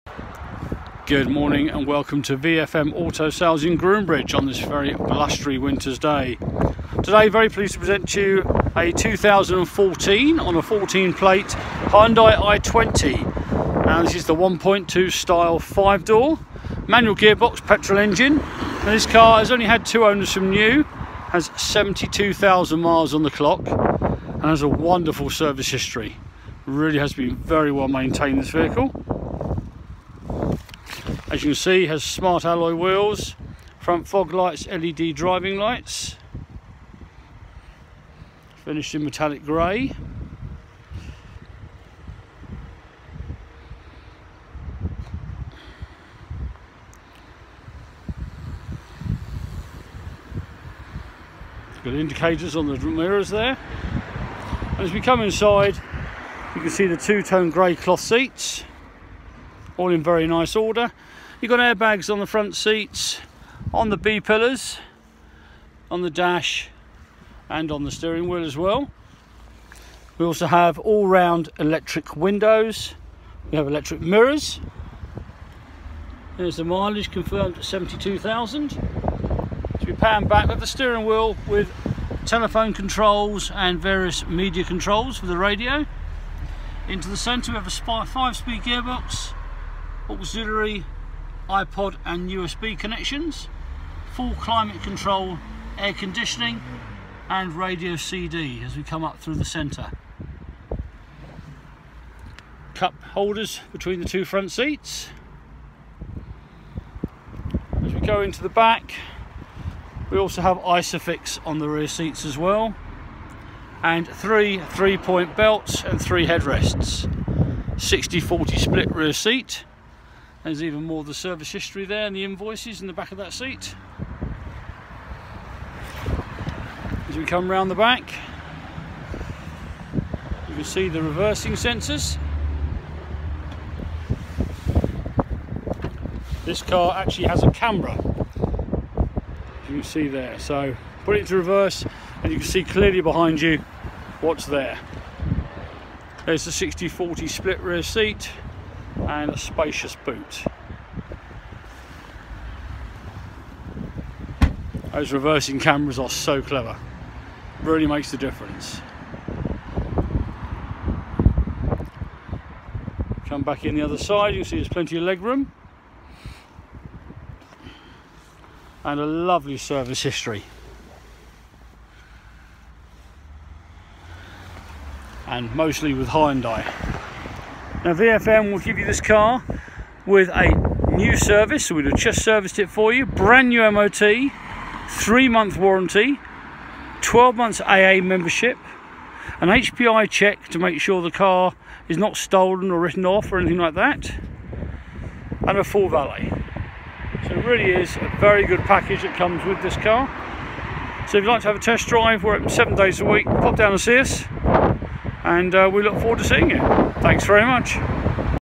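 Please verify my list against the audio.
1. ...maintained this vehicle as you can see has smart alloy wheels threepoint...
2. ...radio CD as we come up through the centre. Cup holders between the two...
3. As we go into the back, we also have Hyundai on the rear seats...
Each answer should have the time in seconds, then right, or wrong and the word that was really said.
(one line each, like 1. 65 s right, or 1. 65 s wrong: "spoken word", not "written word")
1. 27 s wrong: "front", not "threepoint"
2. 97 s right
3. 107 s wrong: "Isofix", not "Hyundai".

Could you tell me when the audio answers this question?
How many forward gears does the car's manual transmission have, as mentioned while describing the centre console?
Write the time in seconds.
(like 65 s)
88 s.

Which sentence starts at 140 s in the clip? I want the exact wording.
So put it to reverse and you can see clearly behind you what's there.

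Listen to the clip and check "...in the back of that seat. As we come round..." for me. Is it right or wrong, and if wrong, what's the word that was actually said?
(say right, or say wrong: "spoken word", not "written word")
right.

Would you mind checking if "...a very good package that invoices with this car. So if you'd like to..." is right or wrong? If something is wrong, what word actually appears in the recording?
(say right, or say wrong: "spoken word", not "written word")
wrong: "comes", not "invoices".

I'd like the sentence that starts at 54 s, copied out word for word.
And as we come inside, you can see the two-tone grey cloth seats, all in very nice order.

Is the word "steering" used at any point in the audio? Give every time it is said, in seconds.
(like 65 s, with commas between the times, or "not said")
67 s, 80 s.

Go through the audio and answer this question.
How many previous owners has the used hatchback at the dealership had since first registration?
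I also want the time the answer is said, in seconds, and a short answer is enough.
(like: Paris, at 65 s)
2, at 19 s.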